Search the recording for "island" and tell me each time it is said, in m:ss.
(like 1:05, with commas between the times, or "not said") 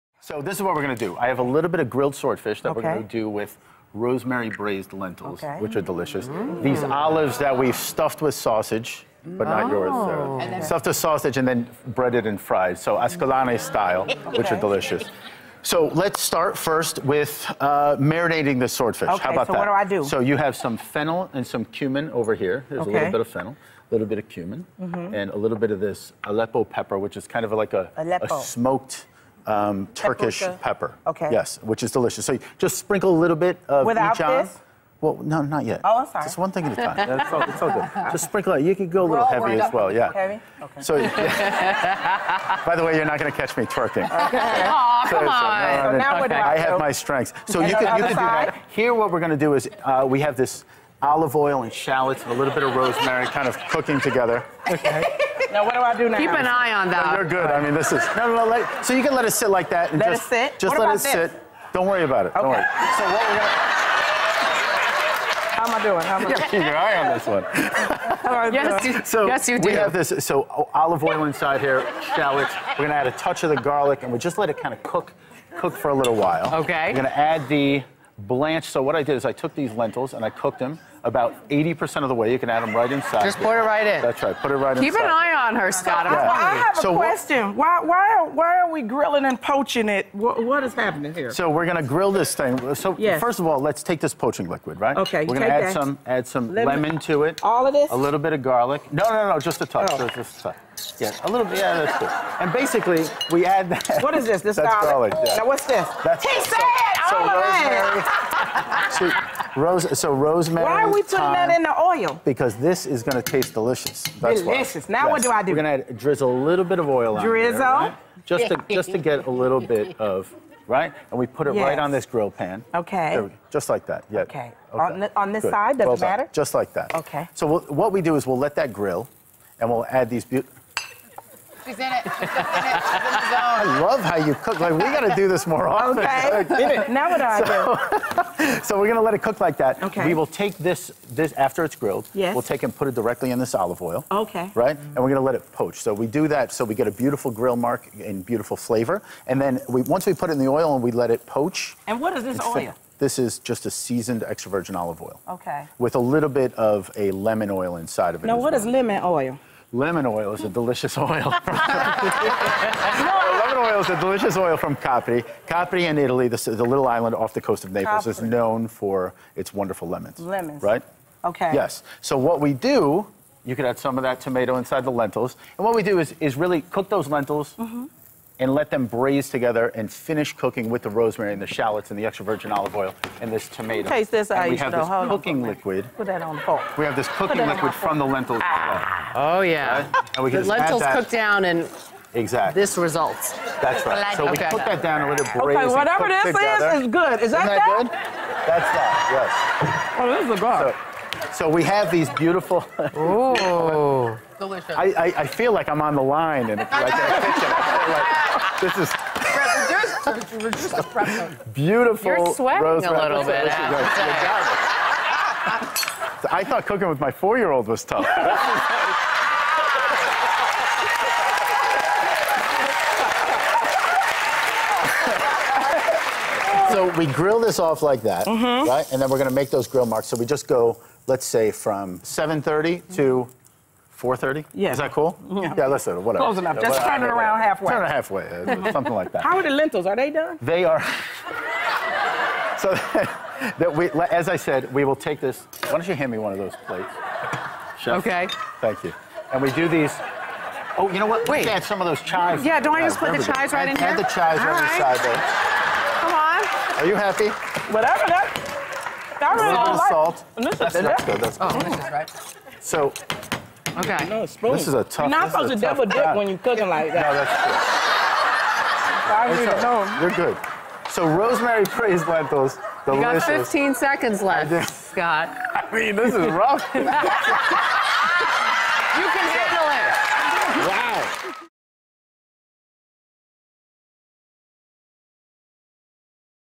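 2:46.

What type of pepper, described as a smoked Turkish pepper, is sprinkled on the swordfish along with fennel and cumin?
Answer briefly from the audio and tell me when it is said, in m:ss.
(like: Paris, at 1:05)
Aleppo pepper, at 0:26.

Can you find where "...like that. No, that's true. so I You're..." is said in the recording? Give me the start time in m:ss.
4:26.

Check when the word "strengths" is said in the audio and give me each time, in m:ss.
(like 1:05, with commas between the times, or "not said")
0:46.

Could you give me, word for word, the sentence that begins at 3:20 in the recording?
So, so we have these beautiful.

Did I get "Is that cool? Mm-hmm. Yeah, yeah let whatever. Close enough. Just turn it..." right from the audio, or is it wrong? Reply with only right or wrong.
right.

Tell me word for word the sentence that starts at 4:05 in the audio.
Why don't you hand me one of those plates?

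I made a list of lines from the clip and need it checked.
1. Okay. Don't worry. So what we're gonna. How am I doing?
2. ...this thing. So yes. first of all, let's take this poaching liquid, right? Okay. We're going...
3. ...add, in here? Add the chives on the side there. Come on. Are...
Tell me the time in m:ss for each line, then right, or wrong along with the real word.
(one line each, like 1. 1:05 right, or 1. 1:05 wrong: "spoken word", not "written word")
1. 1:02 right
2. 1:32 right
3. 4:13 right.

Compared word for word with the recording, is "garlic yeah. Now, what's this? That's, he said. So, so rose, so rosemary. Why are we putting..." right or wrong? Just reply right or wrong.
right.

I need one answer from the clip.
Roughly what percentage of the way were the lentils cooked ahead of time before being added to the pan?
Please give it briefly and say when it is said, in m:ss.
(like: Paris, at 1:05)
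80%, at 1:21.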